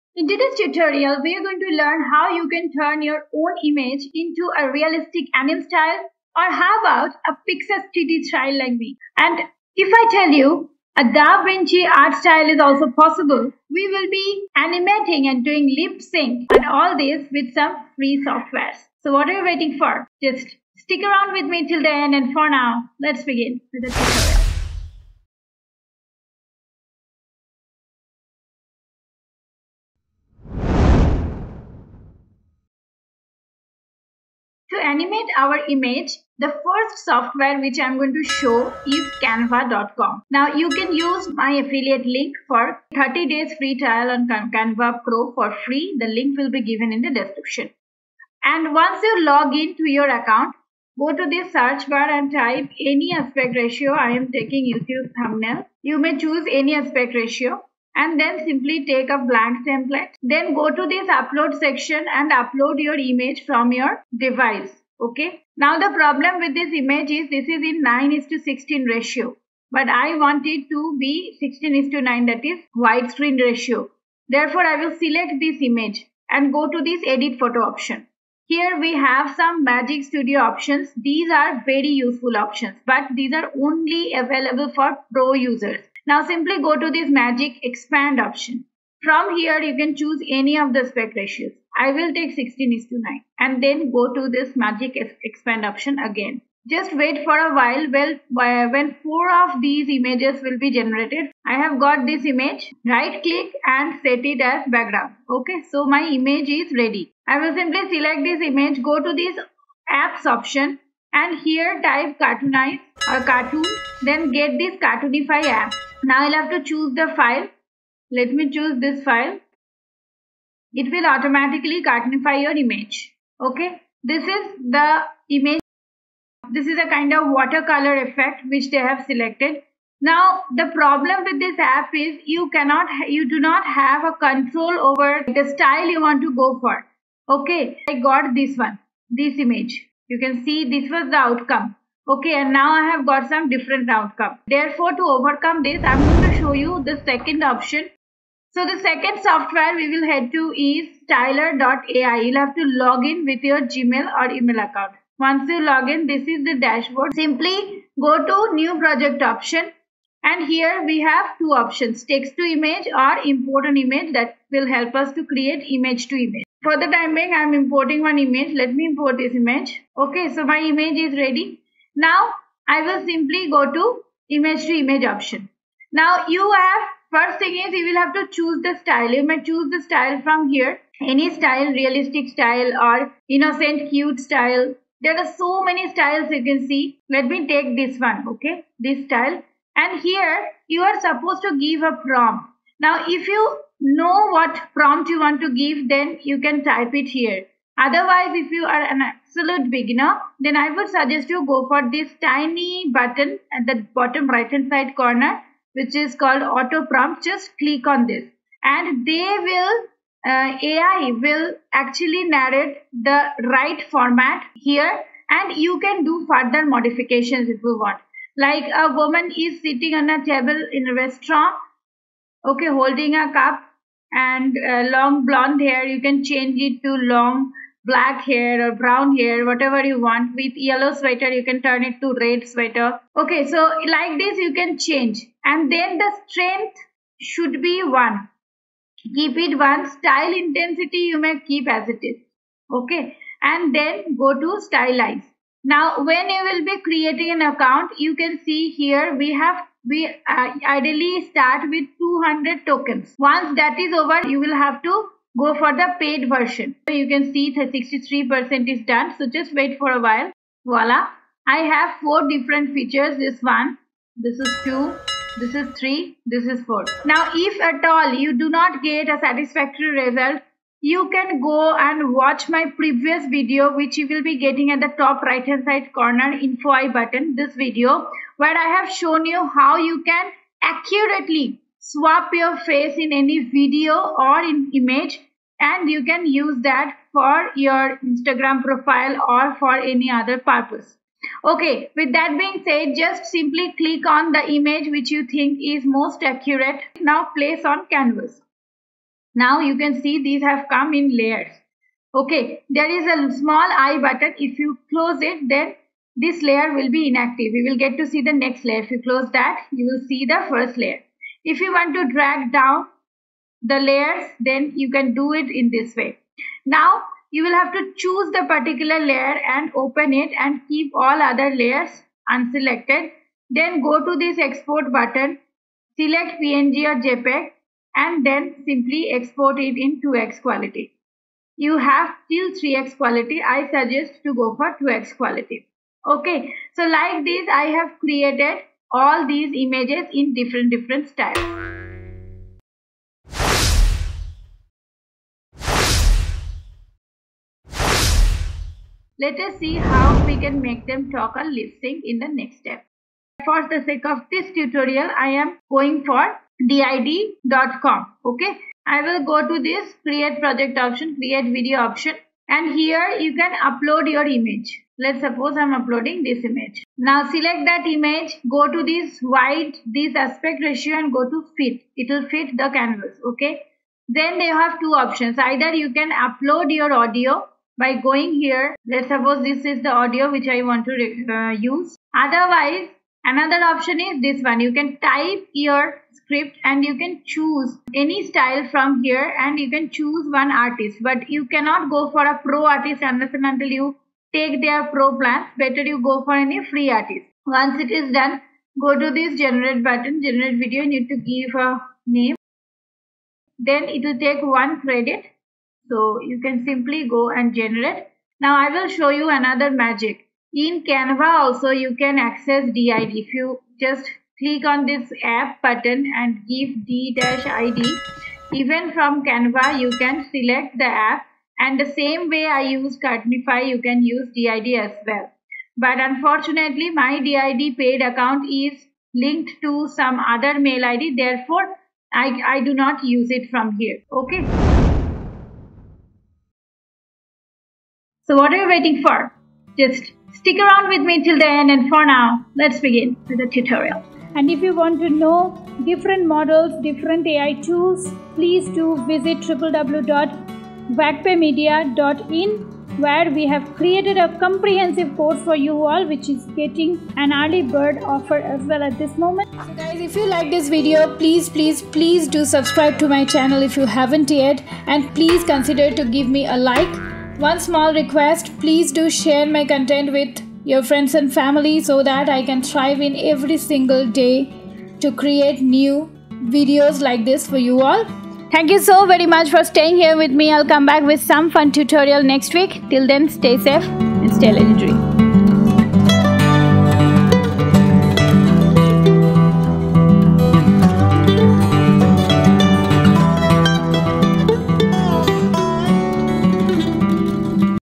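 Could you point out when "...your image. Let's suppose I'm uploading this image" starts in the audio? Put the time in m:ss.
6:04.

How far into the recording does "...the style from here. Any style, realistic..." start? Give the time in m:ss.
2:59.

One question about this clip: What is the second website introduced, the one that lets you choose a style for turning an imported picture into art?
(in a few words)
stylar.ai.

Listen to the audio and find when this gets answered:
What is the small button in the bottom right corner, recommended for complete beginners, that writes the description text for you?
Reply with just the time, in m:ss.
3:26.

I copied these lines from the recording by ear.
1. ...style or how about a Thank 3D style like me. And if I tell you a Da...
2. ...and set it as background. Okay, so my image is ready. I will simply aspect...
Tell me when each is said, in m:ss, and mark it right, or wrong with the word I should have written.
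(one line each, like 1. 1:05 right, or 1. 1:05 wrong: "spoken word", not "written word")
1. 0:05 wrong: "Pixar", not "Thank"
2. 1:43 wrong: "select", not "aspect".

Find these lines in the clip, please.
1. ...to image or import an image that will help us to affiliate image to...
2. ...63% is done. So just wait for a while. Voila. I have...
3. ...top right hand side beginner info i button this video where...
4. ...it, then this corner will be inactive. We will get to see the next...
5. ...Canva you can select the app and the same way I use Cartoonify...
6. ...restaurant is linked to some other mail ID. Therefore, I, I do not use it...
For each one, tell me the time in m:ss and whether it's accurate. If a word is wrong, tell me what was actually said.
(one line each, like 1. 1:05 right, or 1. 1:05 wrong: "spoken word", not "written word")
1. 2:42 wrong: "create", not "affiliate"
2. 4:17 right
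3. 4:34 wrong: "corner", not "beginner"
4. 5:05 wrong: "layer", not "corner"
5. 6:59 right
6. 7:08 wrong: "account", not "restaurant".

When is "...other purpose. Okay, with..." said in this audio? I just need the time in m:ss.
4:50.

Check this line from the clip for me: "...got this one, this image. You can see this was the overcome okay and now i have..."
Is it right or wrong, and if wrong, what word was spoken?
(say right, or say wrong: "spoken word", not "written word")
wrong: "outcome", not "overcome".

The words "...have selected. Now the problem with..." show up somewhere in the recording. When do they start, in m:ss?
2:08.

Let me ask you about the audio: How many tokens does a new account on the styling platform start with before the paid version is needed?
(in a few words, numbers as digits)
200.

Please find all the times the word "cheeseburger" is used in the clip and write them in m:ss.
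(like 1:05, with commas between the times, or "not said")
not said.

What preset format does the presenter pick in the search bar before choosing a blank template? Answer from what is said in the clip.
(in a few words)
YouTube thumbnail.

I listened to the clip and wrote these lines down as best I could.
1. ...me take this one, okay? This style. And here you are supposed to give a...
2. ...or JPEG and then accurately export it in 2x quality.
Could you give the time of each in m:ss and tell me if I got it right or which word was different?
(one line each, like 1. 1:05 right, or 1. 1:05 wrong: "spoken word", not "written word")
1. 3:07 right
2. 5:26 wrong: "simply", not "accurately".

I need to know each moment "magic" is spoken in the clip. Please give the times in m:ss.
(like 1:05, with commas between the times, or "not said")
1:19, 1:27, 1:34, 6:49.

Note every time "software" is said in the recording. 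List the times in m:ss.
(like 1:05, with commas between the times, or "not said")
0:18, 0:37, 2:29.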